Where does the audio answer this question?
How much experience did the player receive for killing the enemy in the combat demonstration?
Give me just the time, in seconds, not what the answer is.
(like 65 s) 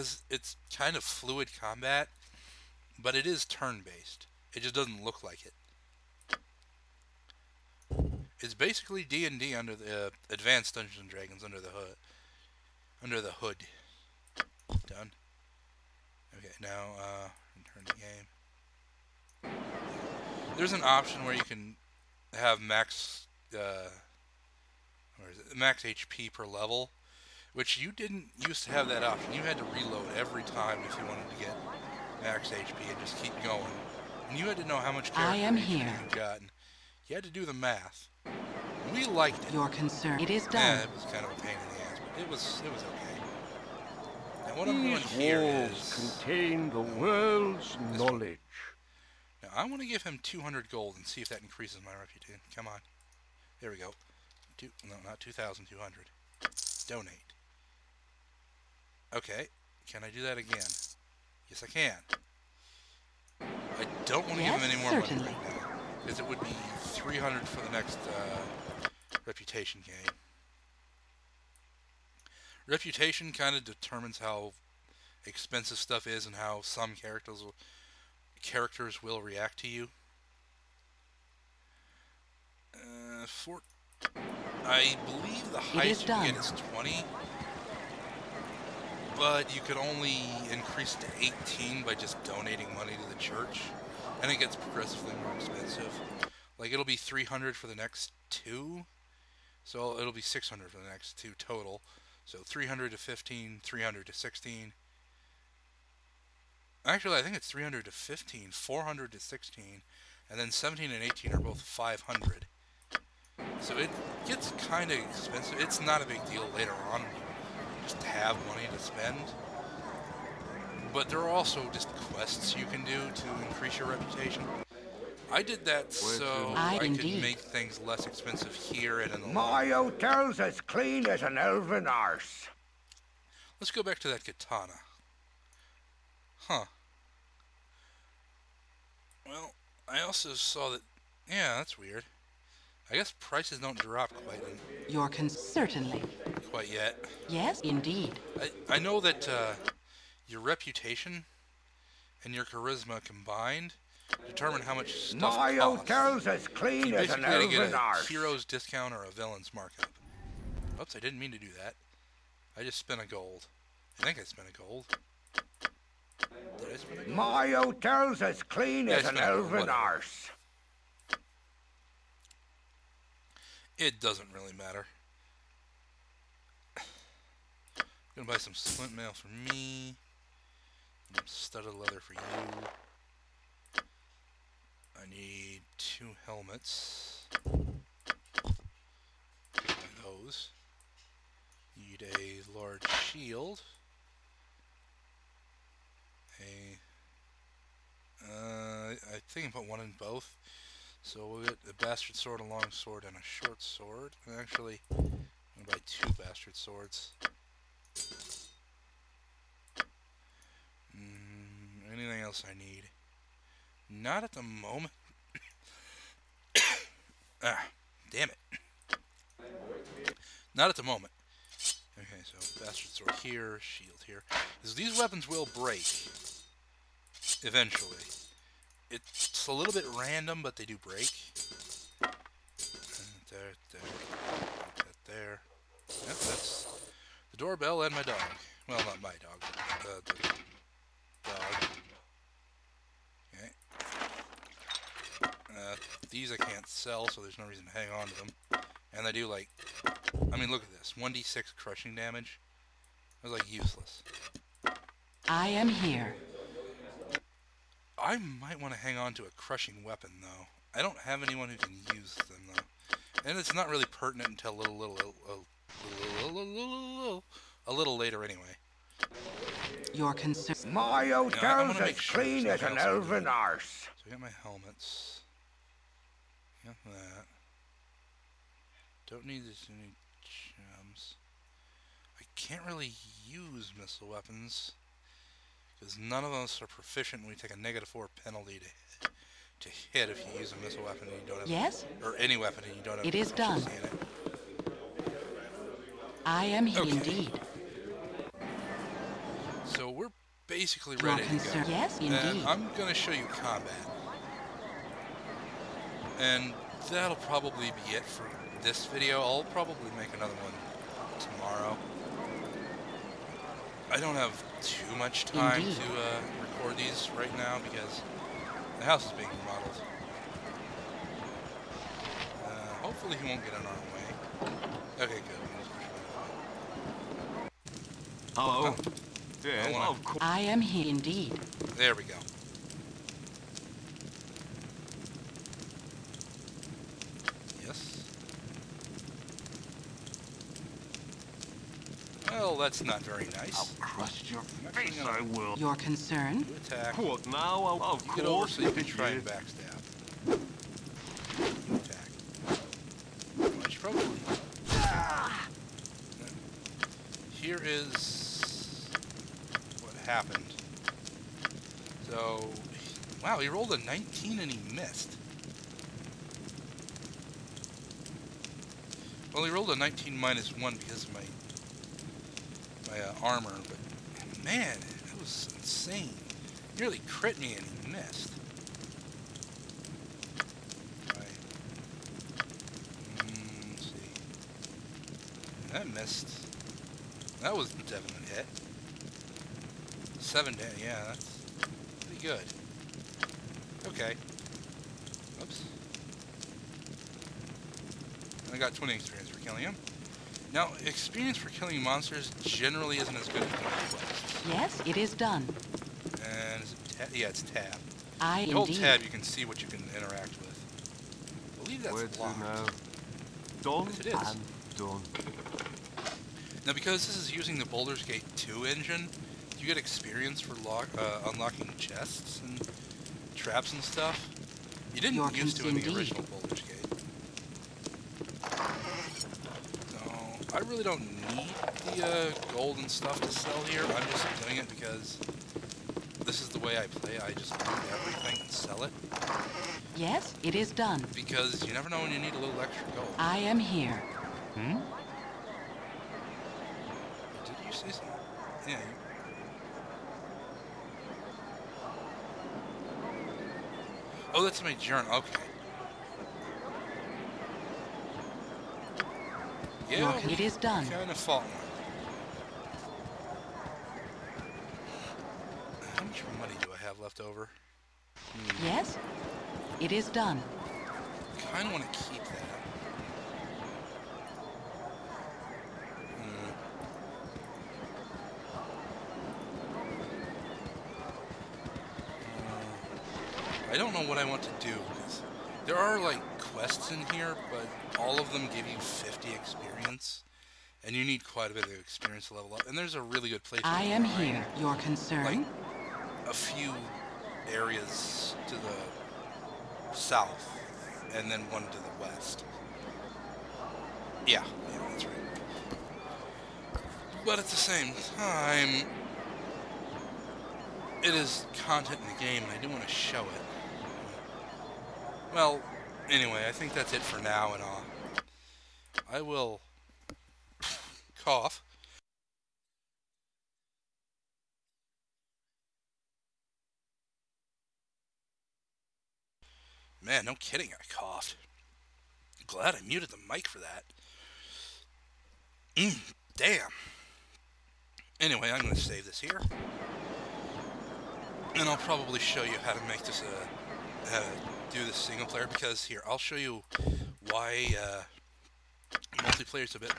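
398 s.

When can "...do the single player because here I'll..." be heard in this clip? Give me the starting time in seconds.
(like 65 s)
544 s.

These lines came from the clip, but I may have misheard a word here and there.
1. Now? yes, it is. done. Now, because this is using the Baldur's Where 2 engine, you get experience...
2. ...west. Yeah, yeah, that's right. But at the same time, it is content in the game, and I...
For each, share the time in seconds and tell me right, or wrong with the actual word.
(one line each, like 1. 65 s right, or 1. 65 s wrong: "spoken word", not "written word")
1. 412 s wrong: "Gate", not "Where"
2. 501 s right.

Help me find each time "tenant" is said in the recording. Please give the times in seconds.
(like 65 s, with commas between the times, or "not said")
not said.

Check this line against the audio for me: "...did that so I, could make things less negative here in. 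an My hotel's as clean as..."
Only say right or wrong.
wrong.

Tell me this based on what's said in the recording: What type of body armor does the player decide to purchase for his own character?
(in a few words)
splint mail.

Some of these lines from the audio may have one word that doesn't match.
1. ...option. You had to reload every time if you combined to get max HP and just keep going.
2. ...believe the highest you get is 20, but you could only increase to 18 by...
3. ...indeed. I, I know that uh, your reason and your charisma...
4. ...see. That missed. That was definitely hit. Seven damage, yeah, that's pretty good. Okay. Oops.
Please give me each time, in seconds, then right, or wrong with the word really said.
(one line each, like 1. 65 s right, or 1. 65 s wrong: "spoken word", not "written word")
1. 29 s wrong: "wanted", not "combined"
2. 85 s right
3. 147 s wrong: "reputation", not "reason"
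4. 383 s right.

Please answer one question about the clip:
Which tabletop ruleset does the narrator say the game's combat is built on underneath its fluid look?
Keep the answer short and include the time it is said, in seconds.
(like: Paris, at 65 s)
Advanced Dungeons and Dragons, at 10 s.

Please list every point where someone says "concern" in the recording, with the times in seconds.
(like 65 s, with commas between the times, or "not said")
39 s, 270 s, 345 s, 494 s.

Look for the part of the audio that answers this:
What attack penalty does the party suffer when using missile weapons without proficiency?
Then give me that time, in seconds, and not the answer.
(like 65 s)
287 s.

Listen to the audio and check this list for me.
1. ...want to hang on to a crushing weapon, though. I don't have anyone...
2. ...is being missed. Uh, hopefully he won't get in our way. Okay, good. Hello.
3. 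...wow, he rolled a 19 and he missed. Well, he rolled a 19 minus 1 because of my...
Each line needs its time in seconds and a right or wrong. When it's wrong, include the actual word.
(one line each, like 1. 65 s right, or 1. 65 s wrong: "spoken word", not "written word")
1. 258 s right
2. 319 s wrong: "remodeled", not "missed"
3. 363 s right.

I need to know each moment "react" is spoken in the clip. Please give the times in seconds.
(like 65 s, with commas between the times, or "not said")
79 s.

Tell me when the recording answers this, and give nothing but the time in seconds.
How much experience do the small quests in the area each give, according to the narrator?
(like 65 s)
488 s.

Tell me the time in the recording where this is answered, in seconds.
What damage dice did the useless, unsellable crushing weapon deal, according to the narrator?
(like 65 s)
250 s.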